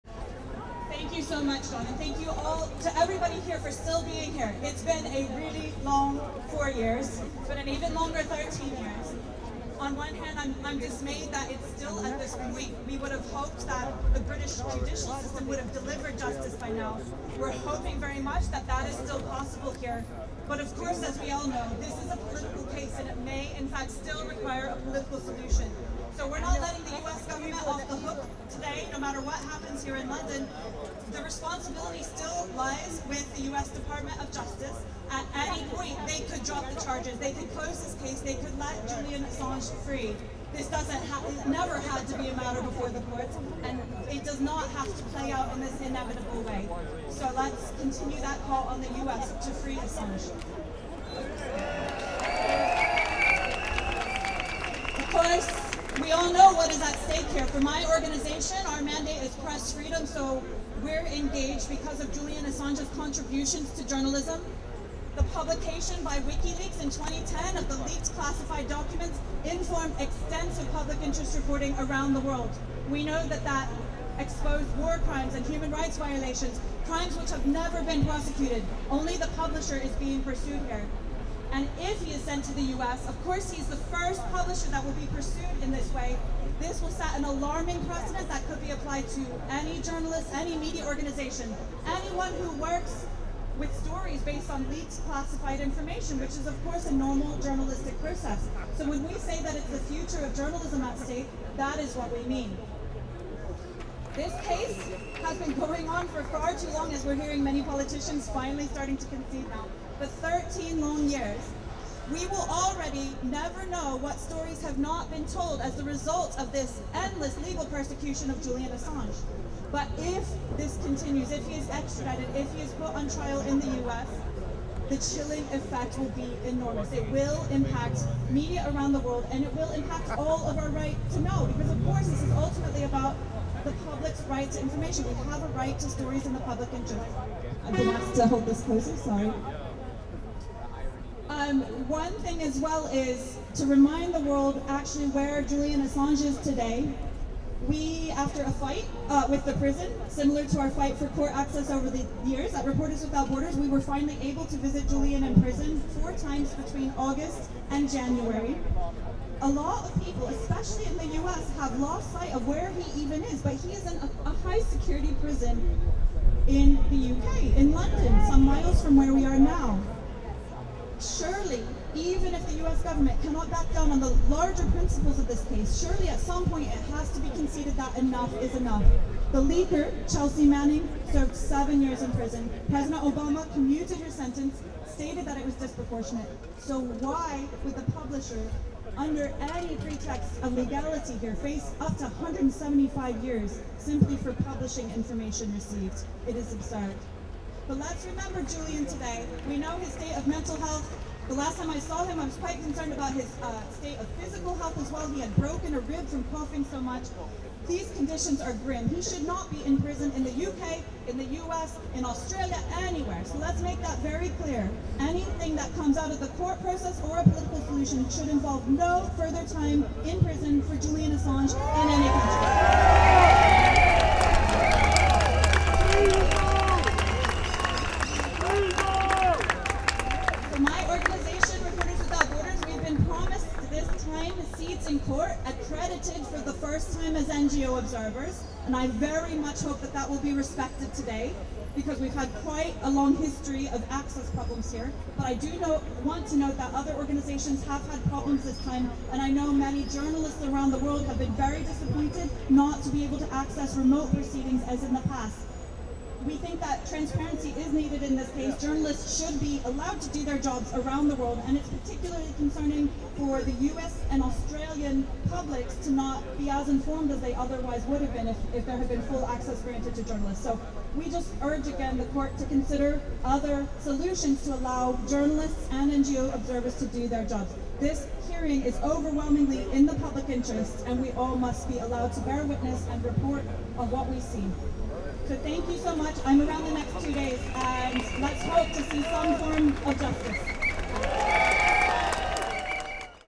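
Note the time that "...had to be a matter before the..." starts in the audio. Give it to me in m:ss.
0:41.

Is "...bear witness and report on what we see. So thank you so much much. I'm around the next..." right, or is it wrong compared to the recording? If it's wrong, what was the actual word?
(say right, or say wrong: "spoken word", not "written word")
right.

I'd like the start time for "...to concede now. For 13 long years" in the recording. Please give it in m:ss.
1:48.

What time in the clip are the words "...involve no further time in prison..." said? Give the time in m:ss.
3:38.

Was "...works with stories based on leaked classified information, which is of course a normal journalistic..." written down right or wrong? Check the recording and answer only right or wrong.
right.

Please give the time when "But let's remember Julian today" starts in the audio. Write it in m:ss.
3:17.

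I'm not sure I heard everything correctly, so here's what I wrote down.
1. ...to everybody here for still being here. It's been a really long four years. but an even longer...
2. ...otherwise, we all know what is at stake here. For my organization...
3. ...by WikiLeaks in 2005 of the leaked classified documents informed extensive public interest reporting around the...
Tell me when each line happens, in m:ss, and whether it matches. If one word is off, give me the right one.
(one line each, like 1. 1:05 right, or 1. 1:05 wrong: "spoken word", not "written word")
1. 0:02 right
2. 0:55 wrong: "course", not "otherwise"
3. 1:06 wrong: "2010", not "2005".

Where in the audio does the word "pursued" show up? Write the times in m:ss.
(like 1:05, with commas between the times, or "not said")
1:20, 1:25.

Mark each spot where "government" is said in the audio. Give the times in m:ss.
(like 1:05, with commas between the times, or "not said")
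0:27, 2:52.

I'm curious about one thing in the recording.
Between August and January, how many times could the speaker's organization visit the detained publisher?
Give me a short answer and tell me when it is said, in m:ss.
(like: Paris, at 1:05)
4 times, at 2:35.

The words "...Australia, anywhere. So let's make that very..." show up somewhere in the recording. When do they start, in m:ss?
3:32.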